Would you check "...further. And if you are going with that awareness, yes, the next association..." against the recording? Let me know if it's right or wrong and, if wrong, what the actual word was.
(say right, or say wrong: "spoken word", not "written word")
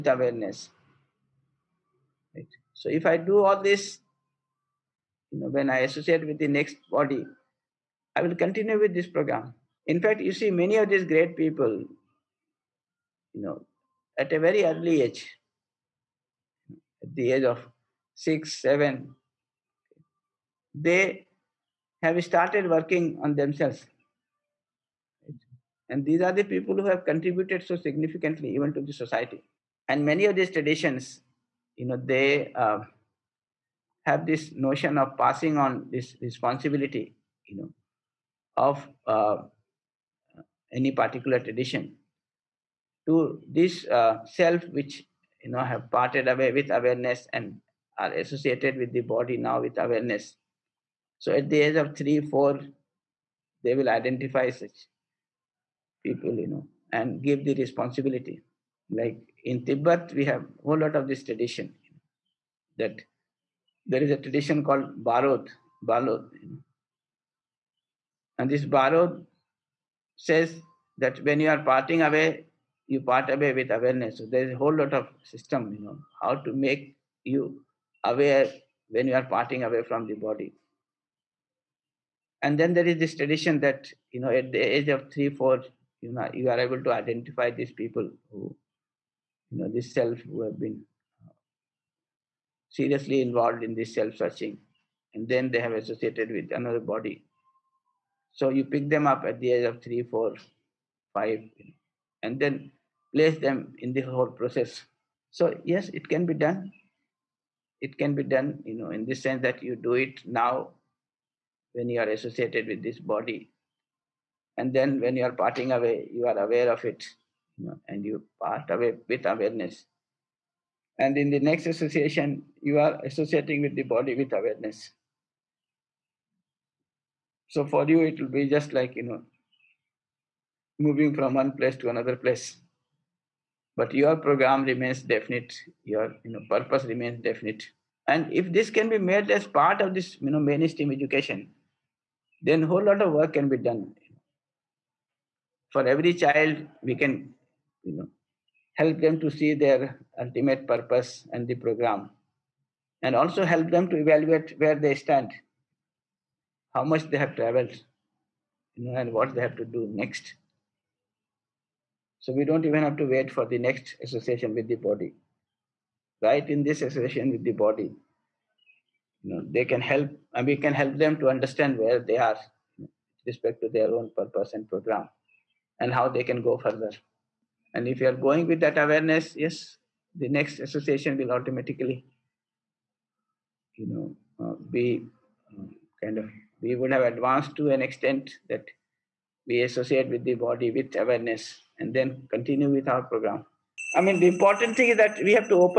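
right.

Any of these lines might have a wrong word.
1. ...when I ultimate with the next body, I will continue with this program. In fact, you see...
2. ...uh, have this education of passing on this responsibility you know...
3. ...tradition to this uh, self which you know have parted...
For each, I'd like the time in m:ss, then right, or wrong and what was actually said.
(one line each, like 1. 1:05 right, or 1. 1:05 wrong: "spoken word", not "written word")
1. 0:05 wrong: "associate", not "ultimate"
2. 0:32 wrong: "notion", not "education"
3. 0:41 right.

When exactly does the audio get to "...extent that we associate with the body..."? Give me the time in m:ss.
3:07.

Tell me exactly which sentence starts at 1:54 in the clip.
And then when you are parting away, you are aware of it you know, and you part away with awareness.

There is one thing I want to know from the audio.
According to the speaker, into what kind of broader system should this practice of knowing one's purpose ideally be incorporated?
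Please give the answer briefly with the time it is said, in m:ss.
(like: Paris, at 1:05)
mainstream education, at 2:20.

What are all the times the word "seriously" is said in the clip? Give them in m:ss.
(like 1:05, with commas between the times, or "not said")
1:32.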